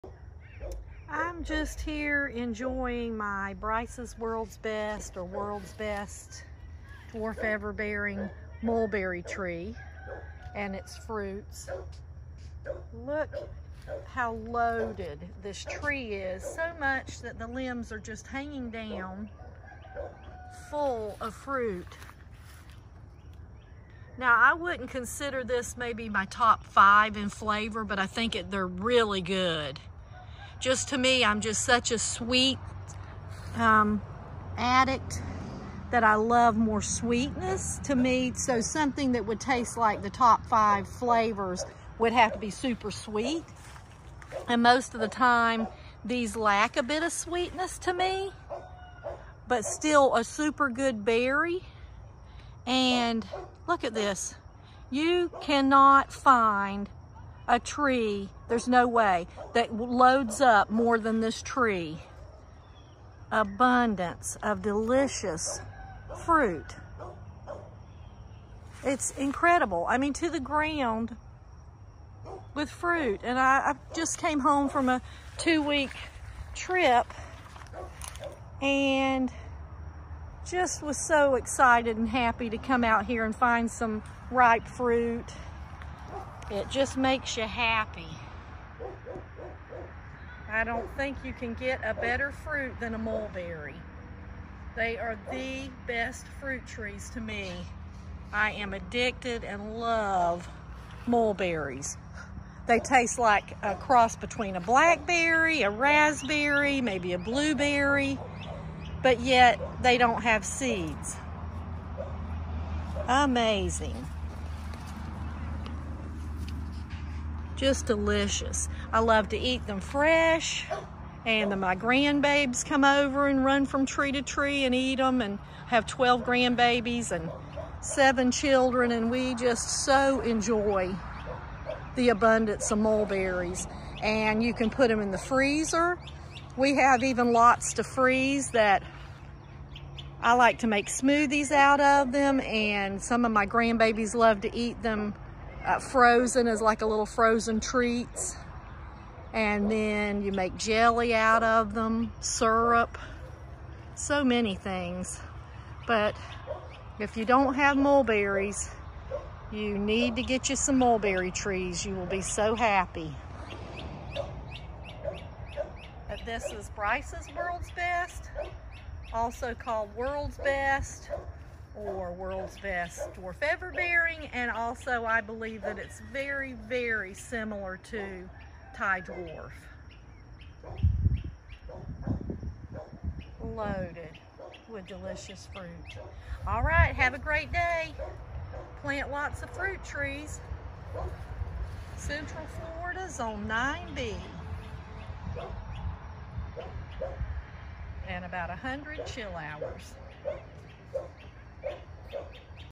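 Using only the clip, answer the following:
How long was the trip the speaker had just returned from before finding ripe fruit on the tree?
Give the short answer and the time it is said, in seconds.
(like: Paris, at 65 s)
2 weeks, at 75 s.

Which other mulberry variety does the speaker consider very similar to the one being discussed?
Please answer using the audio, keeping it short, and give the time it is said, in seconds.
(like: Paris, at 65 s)
Thai Dwarf, at 178 s.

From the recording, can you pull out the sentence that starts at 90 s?
I don't think you can get a better fruit than a mulberry.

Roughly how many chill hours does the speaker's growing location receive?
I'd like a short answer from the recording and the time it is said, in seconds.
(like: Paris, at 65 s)
100, at 198 s.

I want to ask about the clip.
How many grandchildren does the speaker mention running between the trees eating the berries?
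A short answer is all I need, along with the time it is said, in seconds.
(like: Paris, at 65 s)
12, at 125 s.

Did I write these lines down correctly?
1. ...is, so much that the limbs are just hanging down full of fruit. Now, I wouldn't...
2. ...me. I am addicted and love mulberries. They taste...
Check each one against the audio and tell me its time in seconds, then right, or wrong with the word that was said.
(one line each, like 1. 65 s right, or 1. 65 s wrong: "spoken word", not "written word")
1. 16 s right
2. 97 s right.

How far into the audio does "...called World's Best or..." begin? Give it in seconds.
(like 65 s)
169 s.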